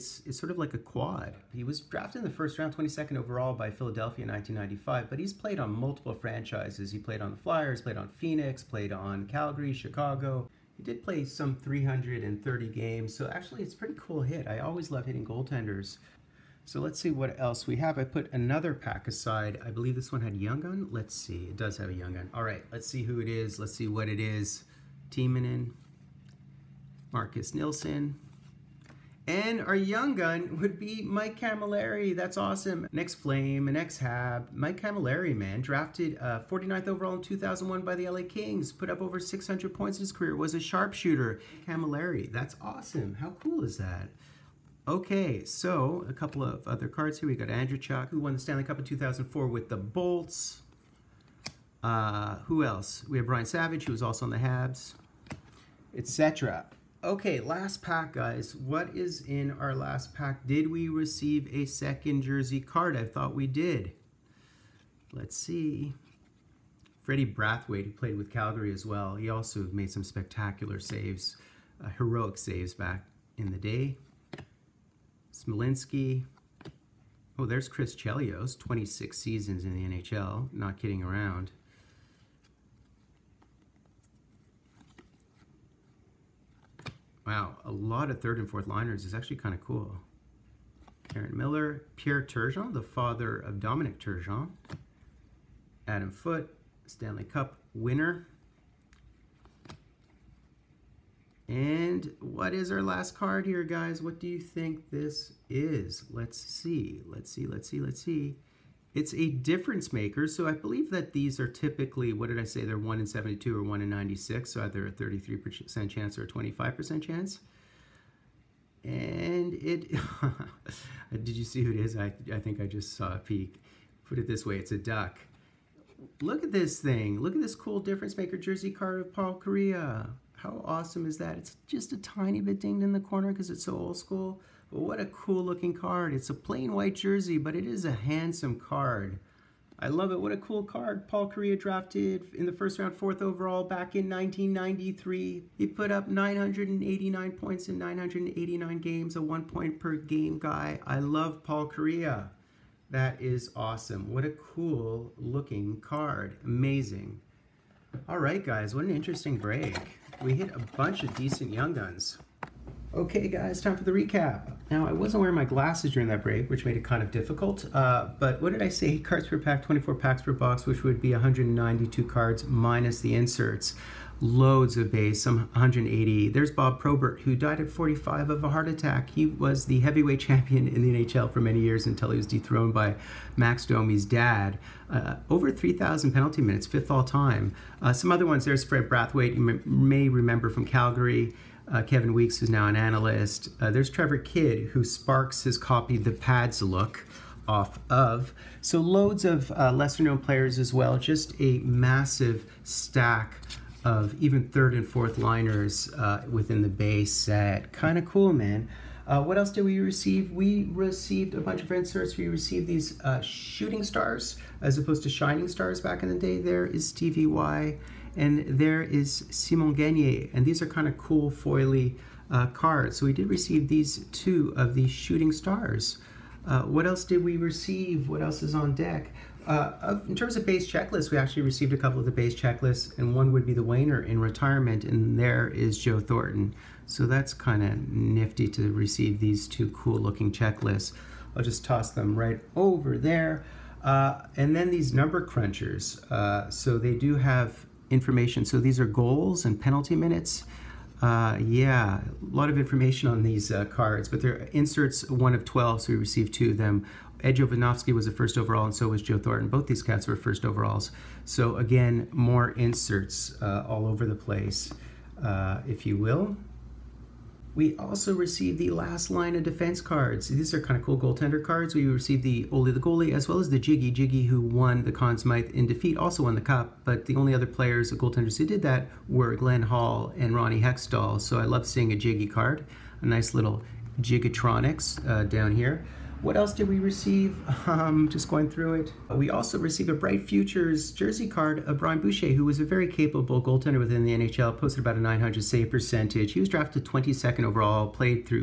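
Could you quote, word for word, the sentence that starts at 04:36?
But the only other players, the goaltenders who did that, were Glenn Hall and Ronnie Hextall.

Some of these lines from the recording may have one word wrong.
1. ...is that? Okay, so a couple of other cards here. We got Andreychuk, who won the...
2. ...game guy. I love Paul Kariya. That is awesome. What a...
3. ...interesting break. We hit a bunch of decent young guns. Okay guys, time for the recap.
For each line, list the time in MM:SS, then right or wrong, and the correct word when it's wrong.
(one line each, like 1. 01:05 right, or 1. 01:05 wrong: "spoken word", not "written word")
1. 00:43 right
2. 02:29 right
3. 02:38 right.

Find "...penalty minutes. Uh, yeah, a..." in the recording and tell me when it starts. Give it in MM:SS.
04:09.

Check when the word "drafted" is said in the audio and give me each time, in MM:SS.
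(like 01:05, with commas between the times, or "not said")
00:01, 00:35, 02:21, 04:56.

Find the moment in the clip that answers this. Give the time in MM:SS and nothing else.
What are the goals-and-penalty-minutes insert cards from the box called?
04:04.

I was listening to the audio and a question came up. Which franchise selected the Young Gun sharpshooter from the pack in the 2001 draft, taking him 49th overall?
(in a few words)
LA Kings.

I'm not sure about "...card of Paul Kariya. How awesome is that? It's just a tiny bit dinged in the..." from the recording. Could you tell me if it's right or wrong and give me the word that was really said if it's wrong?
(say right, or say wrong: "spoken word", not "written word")
right.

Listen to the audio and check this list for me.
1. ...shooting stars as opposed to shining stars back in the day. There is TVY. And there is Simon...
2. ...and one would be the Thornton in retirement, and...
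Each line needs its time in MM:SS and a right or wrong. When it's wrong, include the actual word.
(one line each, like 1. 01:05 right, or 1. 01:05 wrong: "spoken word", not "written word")
1. 03:33 right
2. 03:52 wrong: "Wainer", not "Thornton".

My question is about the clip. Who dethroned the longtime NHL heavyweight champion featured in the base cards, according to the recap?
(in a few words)
Max Domi's dad.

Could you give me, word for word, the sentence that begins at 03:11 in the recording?
Uh, Kevin Weeks, who's now an analyst.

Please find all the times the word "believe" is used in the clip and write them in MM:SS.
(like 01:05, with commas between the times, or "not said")
00:19, 01:50.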